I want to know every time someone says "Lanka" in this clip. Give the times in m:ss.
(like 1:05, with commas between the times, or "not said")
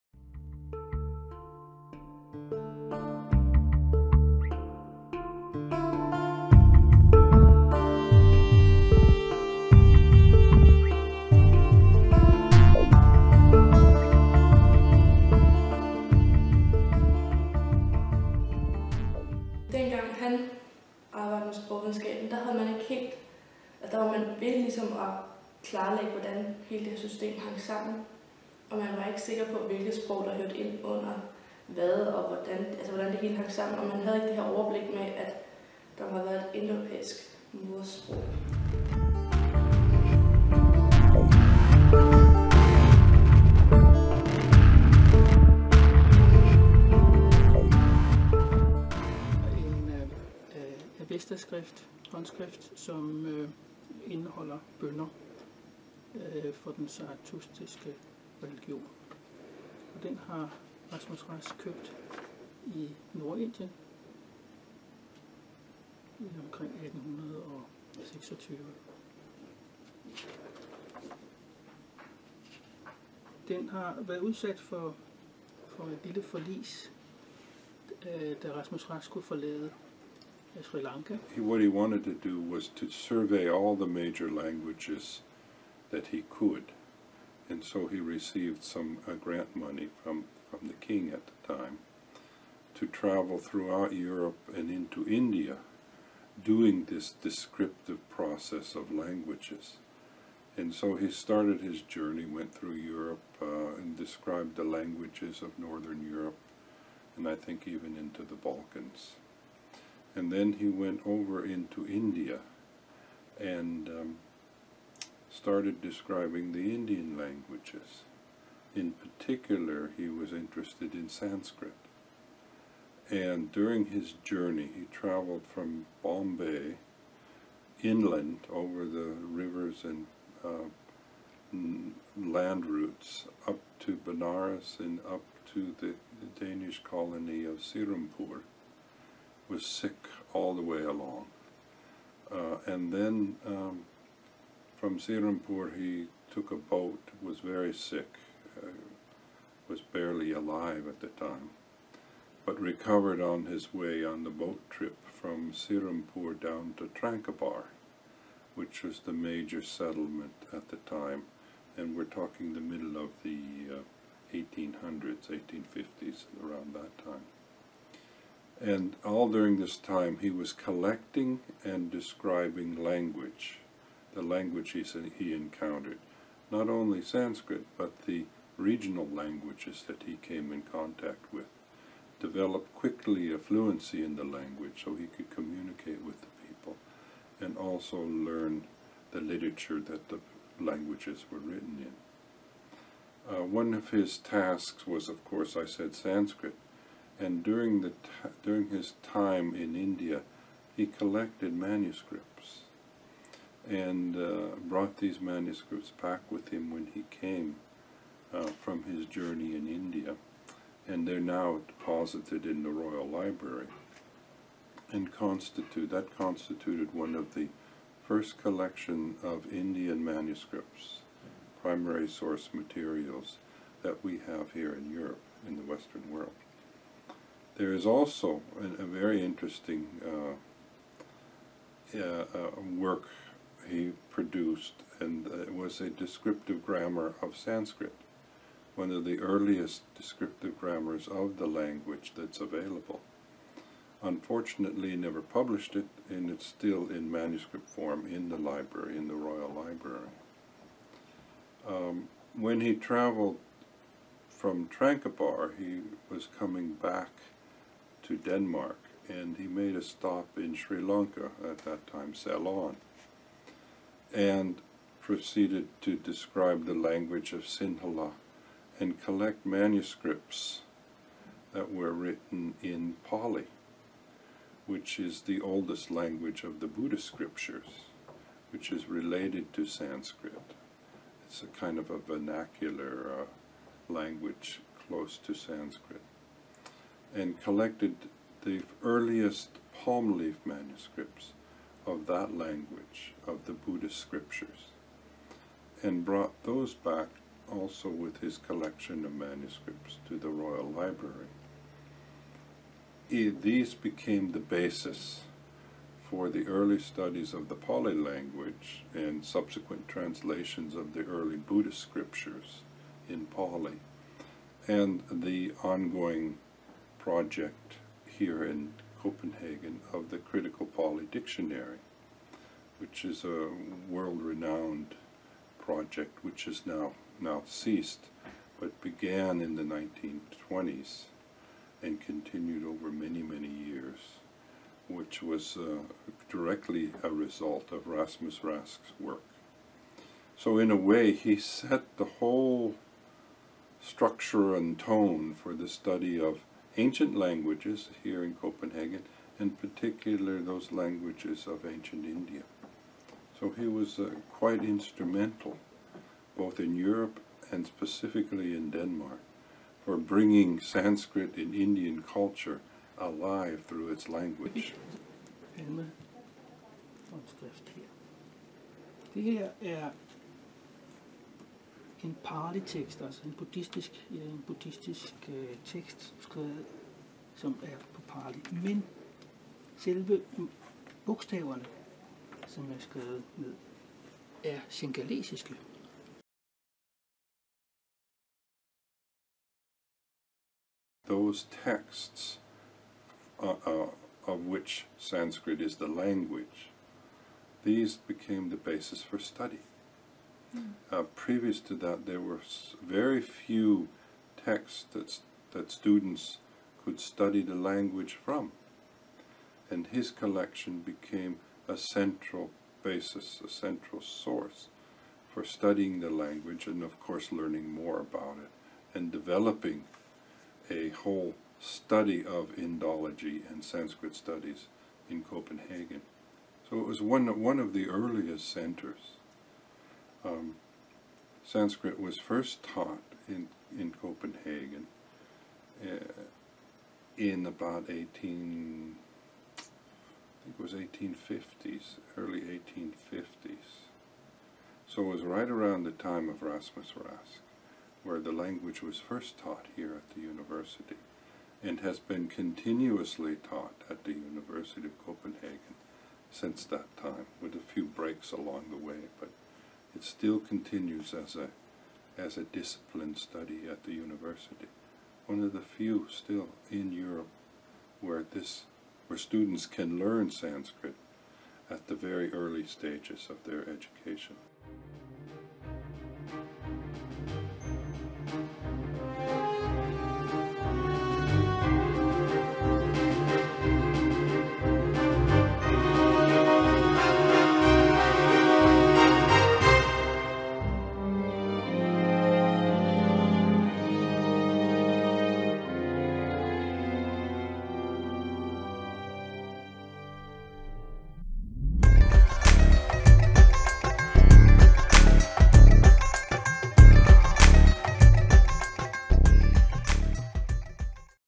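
1:20, 4:20.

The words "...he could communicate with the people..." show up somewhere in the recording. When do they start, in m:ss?
3:04.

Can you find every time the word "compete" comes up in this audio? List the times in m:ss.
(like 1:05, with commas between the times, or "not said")
not said.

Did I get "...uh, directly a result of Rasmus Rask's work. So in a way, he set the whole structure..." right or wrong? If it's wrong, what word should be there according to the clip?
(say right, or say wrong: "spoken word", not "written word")
right.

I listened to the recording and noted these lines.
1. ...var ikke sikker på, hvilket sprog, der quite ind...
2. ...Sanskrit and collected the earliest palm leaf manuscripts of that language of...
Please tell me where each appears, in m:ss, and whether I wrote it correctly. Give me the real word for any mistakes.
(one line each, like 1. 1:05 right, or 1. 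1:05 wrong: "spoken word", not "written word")
1. 0:28 wrong: "hørte", not "quite"
2. 4:45 right.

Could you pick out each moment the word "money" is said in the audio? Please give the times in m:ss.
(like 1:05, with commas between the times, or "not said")
1:29.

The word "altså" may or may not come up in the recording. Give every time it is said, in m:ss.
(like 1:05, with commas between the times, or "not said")
0:32, 6:13.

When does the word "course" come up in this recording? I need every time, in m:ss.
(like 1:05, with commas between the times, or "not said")
3:15, 6:56.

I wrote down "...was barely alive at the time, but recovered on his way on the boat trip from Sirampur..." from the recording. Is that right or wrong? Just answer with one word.
right.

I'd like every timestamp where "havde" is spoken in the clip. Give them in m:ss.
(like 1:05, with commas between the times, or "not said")
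0:22, 0:33.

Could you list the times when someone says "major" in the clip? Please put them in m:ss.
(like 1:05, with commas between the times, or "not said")
1:23, 2:39.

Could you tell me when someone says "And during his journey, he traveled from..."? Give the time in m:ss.
2:03.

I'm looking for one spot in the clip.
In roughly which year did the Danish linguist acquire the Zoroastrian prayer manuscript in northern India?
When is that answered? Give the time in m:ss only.
1:06.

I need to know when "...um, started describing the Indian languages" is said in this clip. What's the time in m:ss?
1:53.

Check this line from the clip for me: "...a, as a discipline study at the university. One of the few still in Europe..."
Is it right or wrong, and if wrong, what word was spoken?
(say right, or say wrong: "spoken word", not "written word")
right.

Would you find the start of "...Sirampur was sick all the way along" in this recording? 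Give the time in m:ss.
2:17.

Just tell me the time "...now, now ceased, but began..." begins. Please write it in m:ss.
5:26.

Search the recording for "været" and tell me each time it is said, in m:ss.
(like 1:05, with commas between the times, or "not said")
0:36, 1:14.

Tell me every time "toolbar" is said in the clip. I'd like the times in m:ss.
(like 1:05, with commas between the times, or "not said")
not said.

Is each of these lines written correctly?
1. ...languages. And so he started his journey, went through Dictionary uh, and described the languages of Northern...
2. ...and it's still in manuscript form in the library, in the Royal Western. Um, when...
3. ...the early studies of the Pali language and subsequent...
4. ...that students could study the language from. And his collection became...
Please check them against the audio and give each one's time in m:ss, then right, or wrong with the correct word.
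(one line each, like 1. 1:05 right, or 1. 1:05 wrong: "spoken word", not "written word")
1. 1:38 wrong: "Europe", not "Dictionary"
2. 4:06 wrong: "Library", not "Western"
3. 5:06 right
4. 6:45 right.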